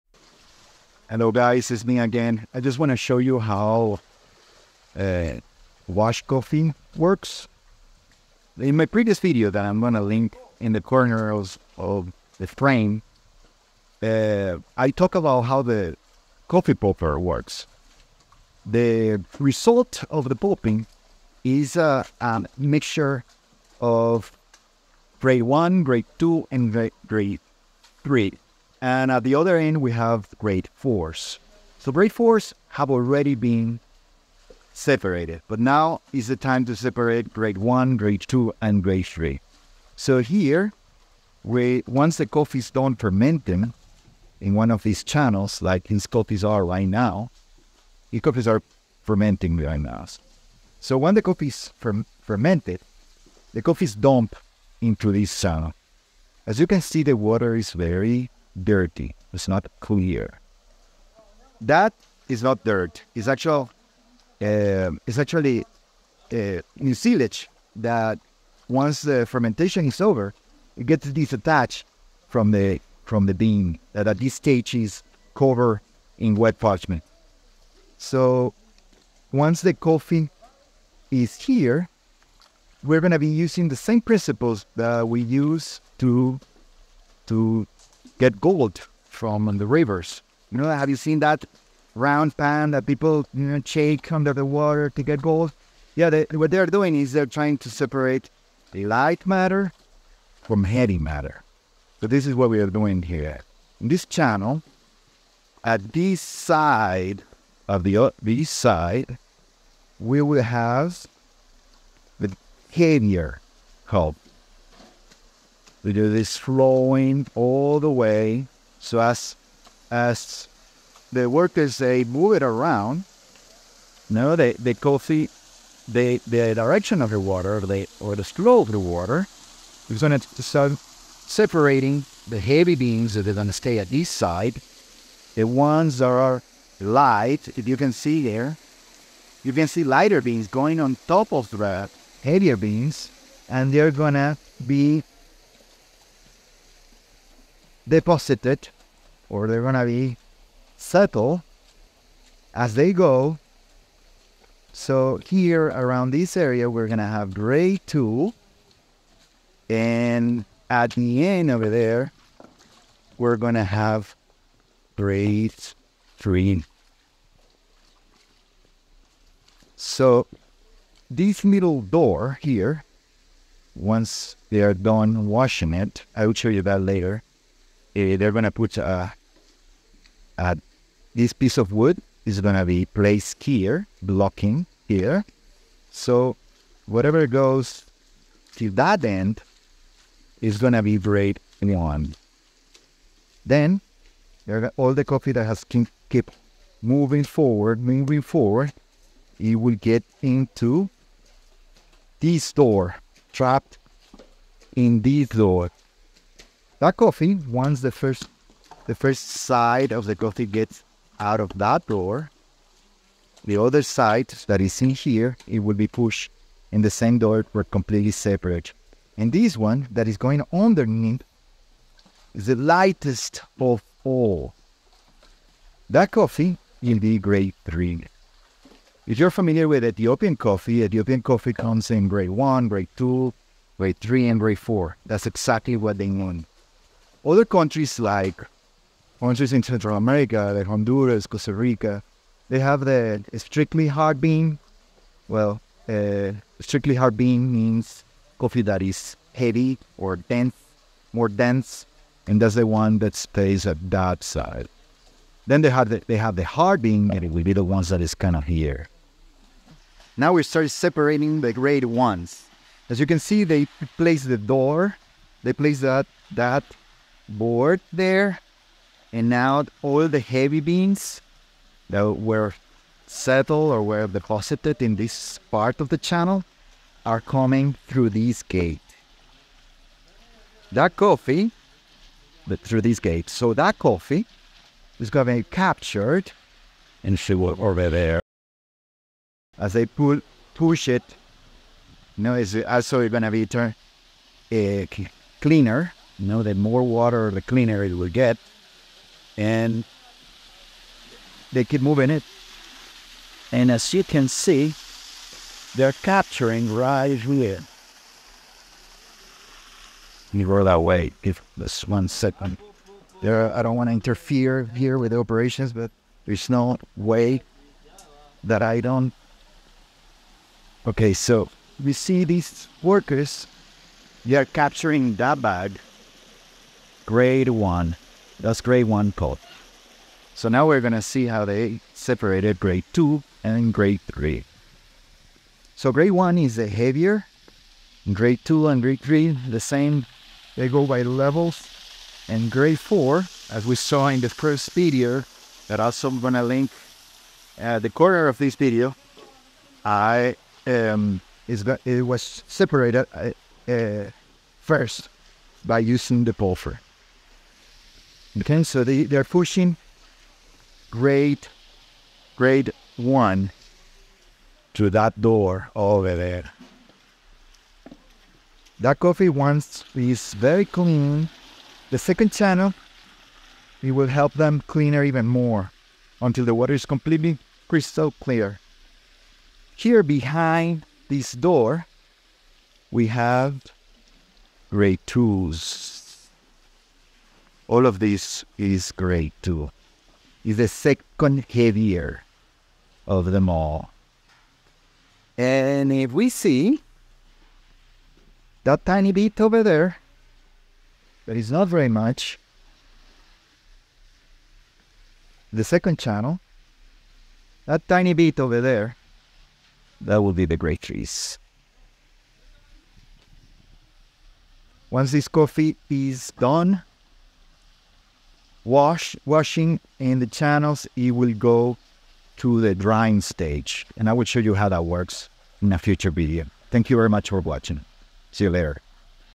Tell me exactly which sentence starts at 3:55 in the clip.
That's exactly what they want other countries like countries in Central America, like Honduras, Costa Rica, they have the strictly hard bean.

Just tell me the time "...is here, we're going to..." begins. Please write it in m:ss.
1:21.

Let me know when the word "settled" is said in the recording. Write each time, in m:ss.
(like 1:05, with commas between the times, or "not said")
2:30, 4:33.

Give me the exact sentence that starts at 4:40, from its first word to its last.
That coffee, but through this gate.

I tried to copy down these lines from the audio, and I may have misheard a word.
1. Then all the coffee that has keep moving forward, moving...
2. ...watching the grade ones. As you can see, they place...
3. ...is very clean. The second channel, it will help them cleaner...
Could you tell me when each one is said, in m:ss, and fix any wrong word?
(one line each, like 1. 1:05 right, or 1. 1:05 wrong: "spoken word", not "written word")
1. 3:13 right
2. 4:20 wrong: "separating", not "watching"
3. 6:09 right.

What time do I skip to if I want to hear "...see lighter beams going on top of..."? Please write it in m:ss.
2:19.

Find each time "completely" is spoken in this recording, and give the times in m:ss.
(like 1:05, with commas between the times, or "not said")
3:37, 6:16.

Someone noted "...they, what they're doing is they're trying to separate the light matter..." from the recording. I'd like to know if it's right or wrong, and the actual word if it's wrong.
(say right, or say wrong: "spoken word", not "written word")
right.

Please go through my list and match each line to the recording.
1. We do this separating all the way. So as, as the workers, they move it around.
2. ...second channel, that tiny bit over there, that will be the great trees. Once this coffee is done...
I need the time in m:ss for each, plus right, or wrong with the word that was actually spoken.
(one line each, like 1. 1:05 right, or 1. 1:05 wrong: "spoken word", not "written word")
1. 1:55 wrong: "flowing", not "separating"
2. 6:45 right.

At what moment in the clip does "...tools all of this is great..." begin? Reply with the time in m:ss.
6:25.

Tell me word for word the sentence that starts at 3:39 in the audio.
And this one that is going underneath is the lightest of all.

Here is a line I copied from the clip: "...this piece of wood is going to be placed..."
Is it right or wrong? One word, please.
right.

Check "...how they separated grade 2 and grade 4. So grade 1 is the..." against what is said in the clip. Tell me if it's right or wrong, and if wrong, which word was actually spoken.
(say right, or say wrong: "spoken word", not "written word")
wrong: "3", not "4".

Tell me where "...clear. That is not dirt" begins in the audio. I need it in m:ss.
0:59.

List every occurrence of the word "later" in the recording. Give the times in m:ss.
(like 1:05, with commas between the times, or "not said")
2:56, 7:08.